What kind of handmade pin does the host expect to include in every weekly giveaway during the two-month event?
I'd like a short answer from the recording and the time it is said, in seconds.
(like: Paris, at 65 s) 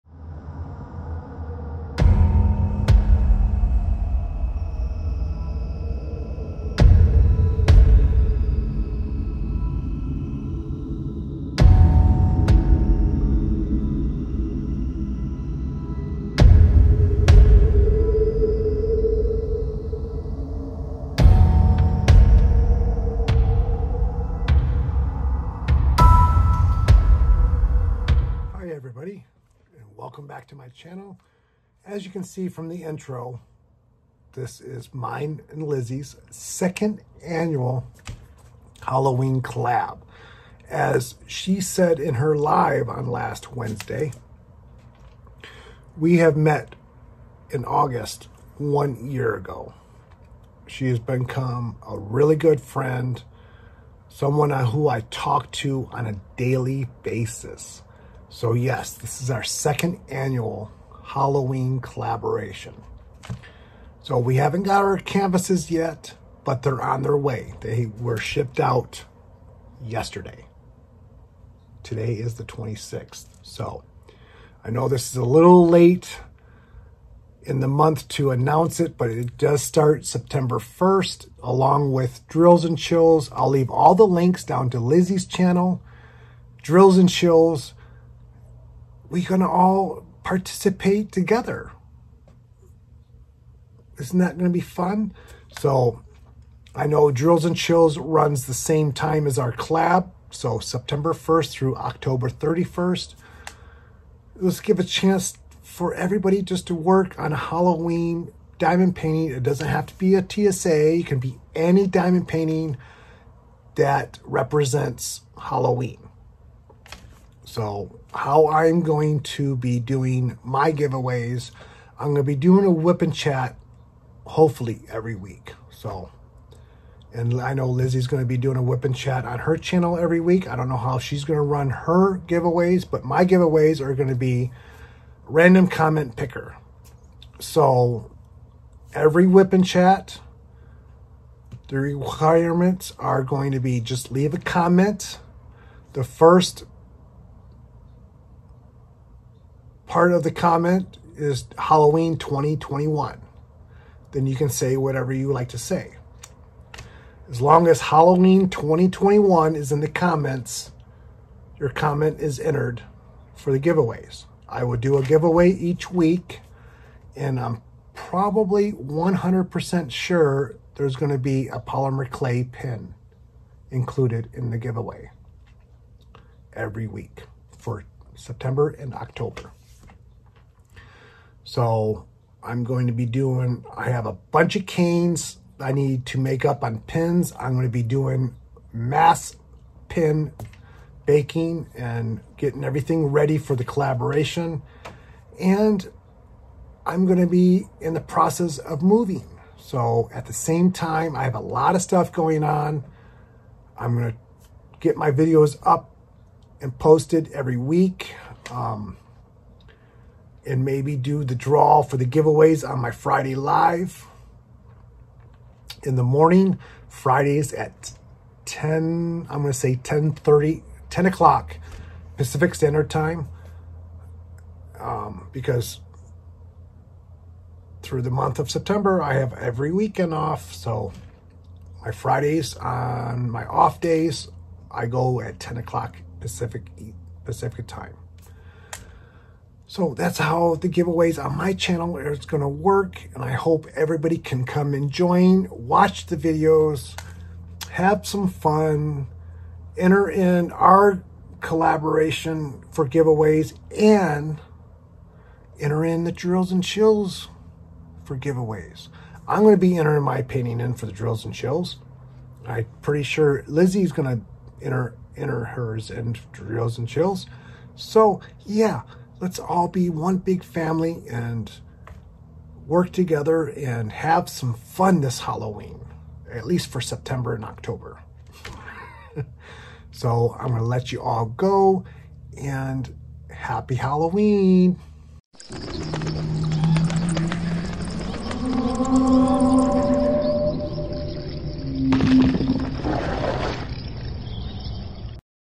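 Polymer clay pin, at 171 s.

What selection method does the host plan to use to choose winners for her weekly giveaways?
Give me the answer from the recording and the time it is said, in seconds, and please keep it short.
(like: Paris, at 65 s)
Random comment picker, at 135 s.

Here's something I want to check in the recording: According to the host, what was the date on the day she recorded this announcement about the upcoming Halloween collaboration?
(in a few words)
26th.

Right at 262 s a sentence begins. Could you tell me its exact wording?
I'm pretty sure Lizzie's going to enter, enter hers in drills and chills.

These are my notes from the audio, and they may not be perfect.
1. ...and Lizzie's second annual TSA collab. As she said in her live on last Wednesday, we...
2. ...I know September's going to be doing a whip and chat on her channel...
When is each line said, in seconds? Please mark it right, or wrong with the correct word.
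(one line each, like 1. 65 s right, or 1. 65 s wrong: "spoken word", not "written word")
1. 35 s wrong: "Halloween", not "TSA"
2. 127 s wrong: "Lizzie", not "September".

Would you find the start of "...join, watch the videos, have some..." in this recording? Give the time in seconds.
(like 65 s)
244 s.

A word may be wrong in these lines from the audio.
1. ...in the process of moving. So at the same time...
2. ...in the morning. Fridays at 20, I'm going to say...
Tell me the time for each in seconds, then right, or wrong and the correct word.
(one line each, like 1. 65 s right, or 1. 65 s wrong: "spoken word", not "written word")
1. 197 s right
2. 215 s wrong: "10", not "20".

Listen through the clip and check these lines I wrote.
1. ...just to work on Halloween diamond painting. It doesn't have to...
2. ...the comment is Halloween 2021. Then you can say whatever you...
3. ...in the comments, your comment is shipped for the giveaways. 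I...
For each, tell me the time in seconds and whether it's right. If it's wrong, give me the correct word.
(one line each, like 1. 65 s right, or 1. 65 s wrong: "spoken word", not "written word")
1. 106 s right
2. 150 s right
3. 159 s wrong: "entered", not "shipped".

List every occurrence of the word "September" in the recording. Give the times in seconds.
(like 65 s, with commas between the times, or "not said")
80 s, 100 s, 178 s, 228 s, 276 s.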